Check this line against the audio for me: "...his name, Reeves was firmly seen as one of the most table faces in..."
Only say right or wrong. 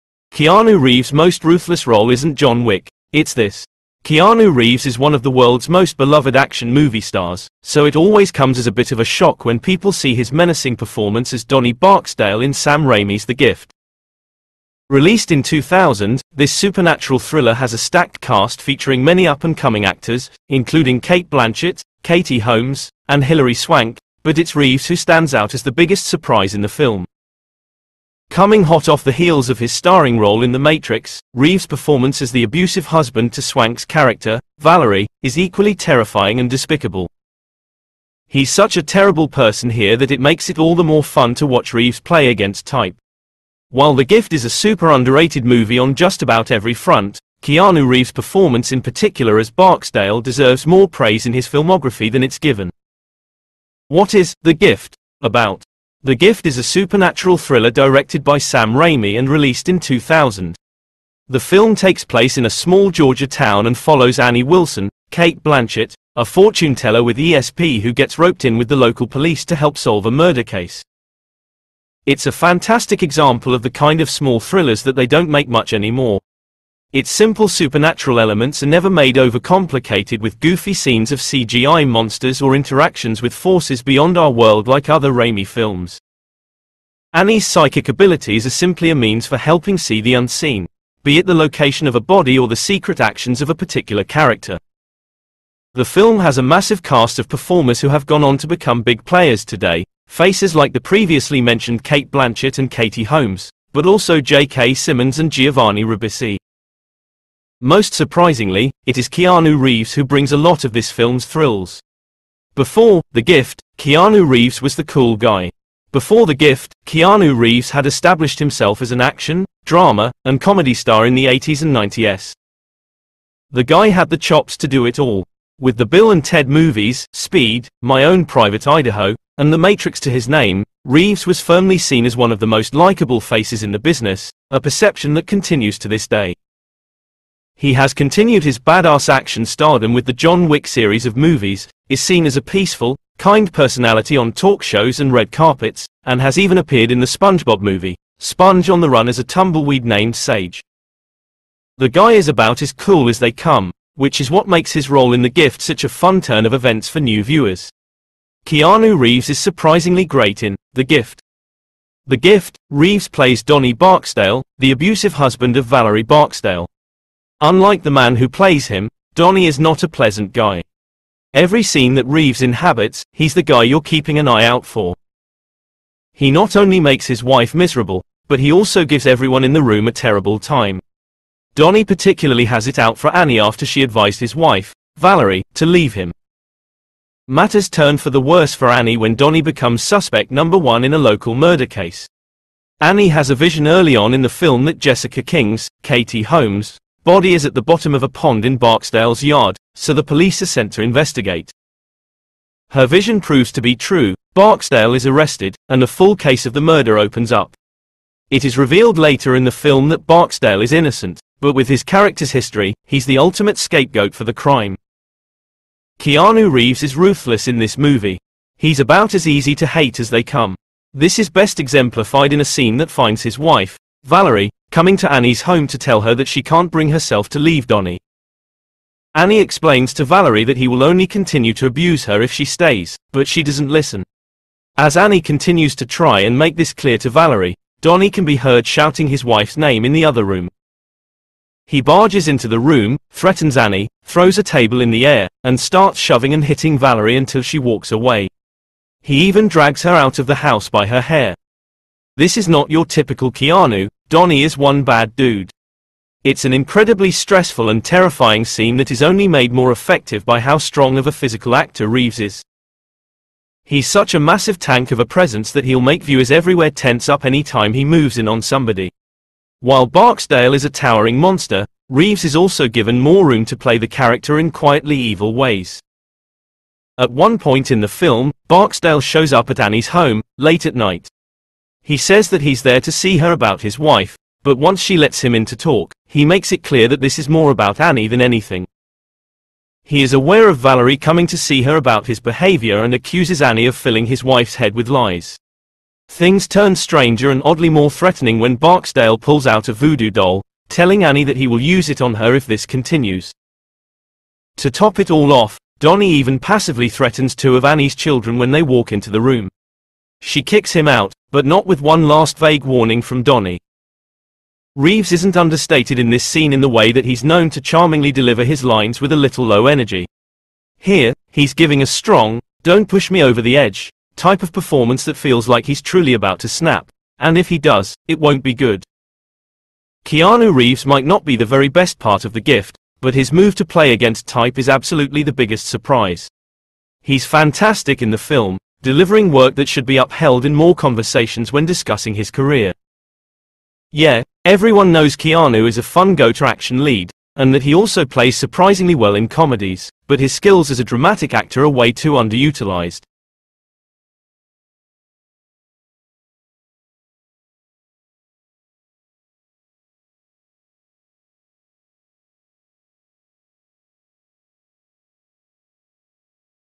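wrong.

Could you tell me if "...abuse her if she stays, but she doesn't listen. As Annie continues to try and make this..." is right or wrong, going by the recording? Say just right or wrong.
right.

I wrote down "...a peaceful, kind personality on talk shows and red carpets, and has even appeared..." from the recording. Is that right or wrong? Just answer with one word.
right.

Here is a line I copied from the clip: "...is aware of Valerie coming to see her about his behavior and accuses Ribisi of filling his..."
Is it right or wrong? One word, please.
wrong.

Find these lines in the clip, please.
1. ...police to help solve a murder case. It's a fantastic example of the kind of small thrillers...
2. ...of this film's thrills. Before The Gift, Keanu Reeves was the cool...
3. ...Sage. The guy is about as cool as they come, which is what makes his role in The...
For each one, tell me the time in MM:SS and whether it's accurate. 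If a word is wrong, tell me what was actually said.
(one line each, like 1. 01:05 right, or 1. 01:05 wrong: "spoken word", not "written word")
1. 01:09 right
2. 01:50 right
3. 02:30 right.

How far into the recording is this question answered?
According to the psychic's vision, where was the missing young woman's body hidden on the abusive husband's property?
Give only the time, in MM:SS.
03:18.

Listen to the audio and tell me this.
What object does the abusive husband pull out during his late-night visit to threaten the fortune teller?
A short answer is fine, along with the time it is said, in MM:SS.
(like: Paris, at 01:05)
A voodoo doll, at 04:59.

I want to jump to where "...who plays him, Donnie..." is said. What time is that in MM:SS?
02:48.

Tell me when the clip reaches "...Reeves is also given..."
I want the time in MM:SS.
04:31.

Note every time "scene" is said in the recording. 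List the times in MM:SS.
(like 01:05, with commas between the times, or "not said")
01:20, 02:51, 03:42, 04:18, 05:16.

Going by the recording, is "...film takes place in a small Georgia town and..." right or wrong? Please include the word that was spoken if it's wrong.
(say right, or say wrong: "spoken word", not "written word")
right.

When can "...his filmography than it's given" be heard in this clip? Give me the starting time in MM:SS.
00:51.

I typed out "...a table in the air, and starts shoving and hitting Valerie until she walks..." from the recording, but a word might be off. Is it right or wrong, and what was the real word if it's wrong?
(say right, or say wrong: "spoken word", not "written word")
right.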